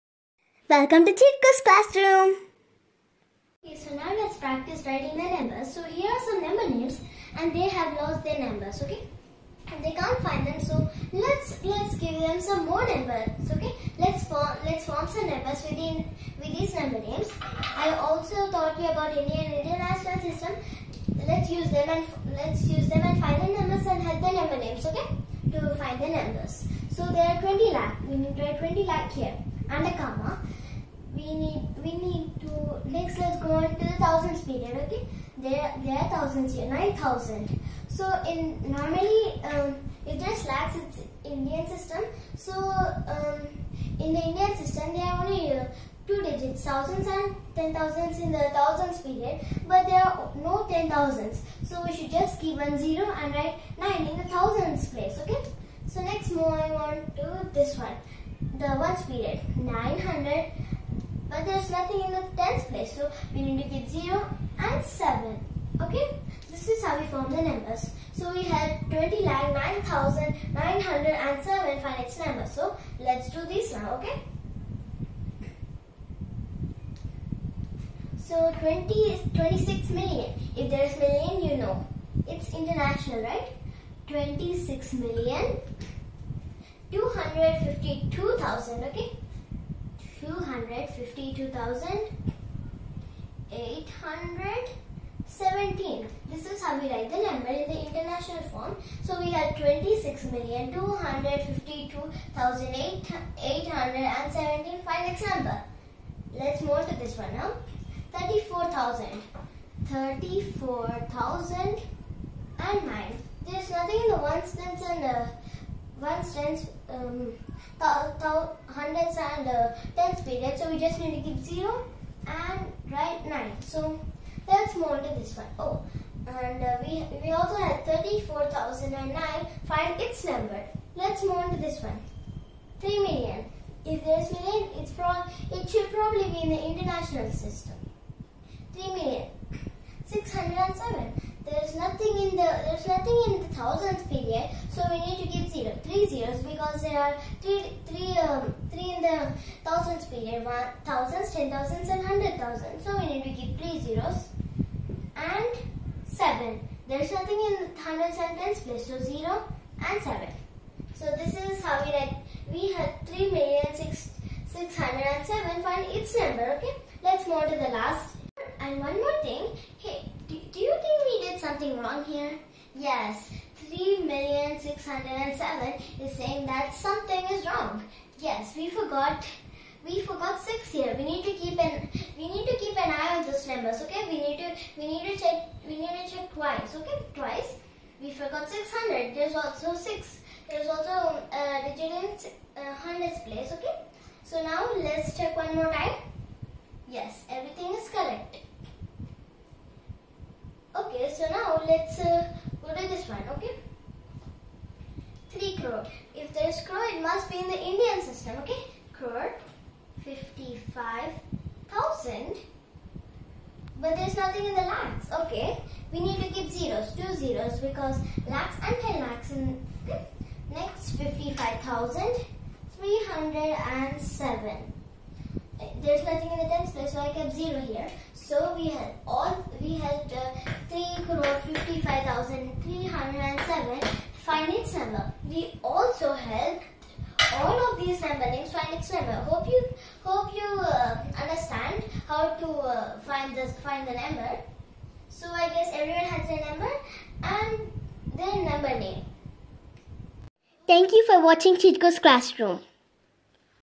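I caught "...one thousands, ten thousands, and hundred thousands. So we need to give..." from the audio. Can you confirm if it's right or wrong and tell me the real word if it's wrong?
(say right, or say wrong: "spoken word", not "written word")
right.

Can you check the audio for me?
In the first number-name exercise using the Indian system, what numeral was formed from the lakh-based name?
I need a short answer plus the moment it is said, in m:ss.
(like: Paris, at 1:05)
20,09,907, at 1:08.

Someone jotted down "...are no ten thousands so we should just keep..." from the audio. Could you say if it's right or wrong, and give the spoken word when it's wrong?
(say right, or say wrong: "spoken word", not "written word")
right.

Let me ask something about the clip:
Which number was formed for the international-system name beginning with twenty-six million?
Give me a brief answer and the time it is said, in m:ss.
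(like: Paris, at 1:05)
26,252,817, at 1:39.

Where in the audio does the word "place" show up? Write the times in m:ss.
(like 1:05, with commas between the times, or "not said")
0:54, 1:02, 2:38, 3:13, 3:46.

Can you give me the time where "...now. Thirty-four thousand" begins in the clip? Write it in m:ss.
1:47.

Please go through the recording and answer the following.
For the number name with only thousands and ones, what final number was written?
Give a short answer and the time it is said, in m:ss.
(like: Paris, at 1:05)
34,009, at 2:07.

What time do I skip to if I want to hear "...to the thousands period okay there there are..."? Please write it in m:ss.
0:33.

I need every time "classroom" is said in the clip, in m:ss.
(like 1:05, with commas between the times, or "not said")
0:01, 4:11.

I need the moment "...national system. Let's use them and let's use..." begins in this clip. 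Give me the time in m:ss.
0:19.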